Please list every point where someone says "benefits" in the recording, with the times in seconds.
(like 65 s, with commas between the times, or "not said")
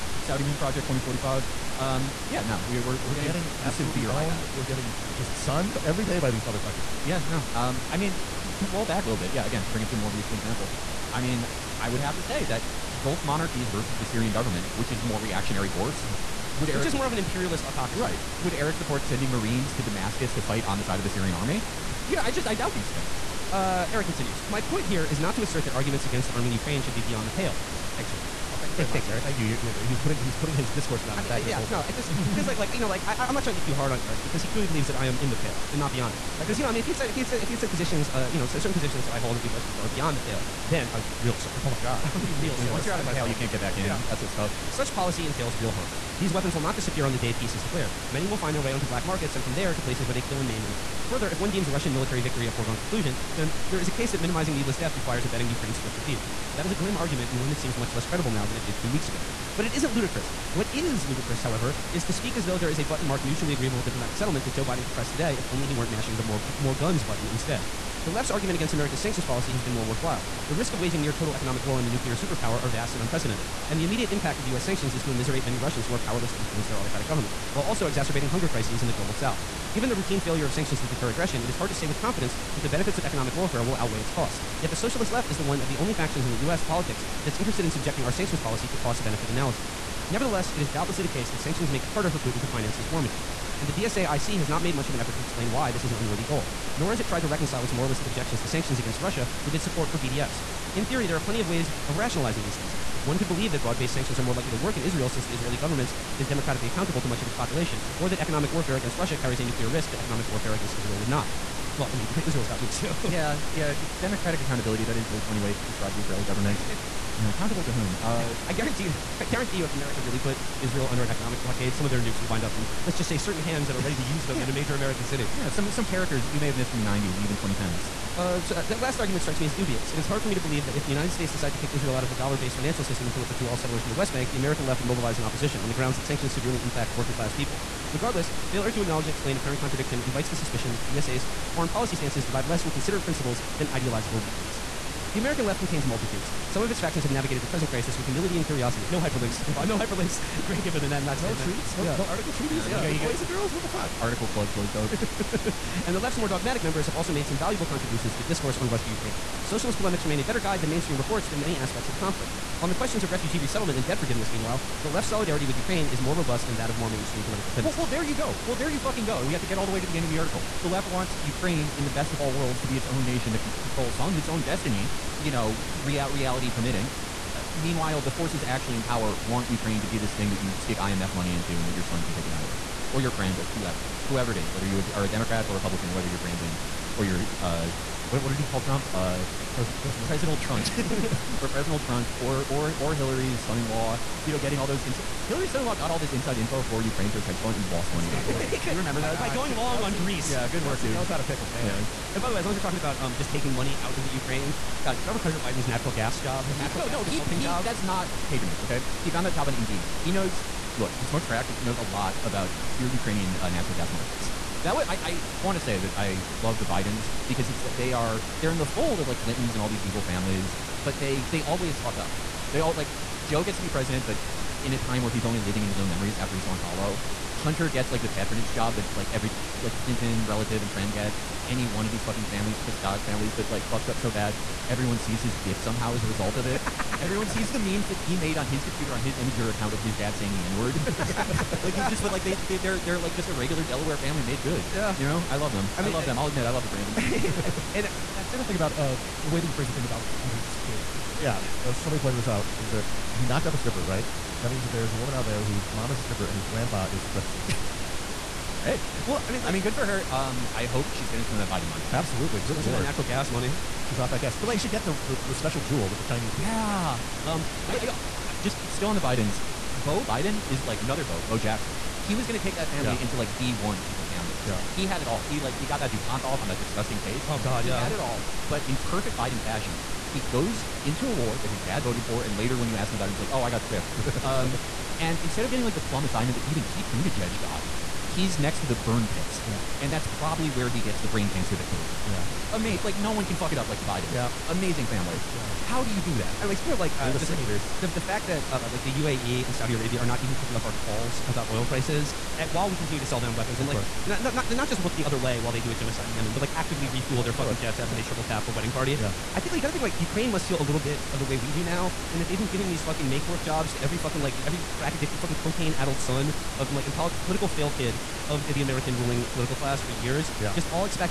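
82 s, 89 s.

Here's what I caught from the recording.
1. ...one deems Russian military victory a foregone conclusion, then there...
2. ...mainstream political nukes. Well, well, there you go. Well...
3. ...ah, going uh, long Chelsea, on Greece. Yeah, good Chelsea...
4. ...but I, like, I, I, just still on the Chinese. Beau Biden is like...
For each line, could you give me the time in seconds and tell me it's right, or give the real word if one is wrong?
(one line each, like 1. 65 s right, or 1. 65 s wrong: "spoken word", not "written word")
1. 51 s right
2. 166 s wrong: "tendencies", not "nukes"
3. 199 s right
4. 267 s wrong: "Bidens", not "Chinese".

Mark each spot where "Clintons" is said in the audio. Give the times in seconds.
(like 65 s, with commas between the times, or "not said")
219 s, 229 s.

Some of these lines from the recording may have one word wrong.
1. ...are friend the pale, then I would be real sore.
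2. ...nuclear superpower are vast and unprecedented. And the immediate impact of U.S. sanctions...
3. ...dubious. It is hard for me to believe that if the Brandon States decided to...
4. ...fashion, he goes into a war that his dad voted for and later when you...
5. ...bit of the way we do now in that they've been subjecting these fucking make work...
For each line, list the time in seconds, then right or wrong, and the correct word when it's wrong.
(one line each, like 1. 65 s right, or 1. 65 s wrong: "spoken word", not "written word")
1. 39 s wrong: "beyond", not "friend"
2. 71 s right
3. 129 s wrong: "United", not "Brandon"
4. 279 s right
5. 310 s wrong: "giving", not "subjecting".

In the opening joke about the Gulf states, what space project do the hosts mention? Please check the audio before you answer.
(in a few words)
Saudi Moon Project 2045.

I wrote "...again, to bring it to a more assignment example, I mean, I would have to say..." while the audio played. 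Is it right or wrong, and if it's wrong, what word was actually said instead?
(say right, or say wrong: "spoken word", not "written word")
wrong: "recent", not "assignment".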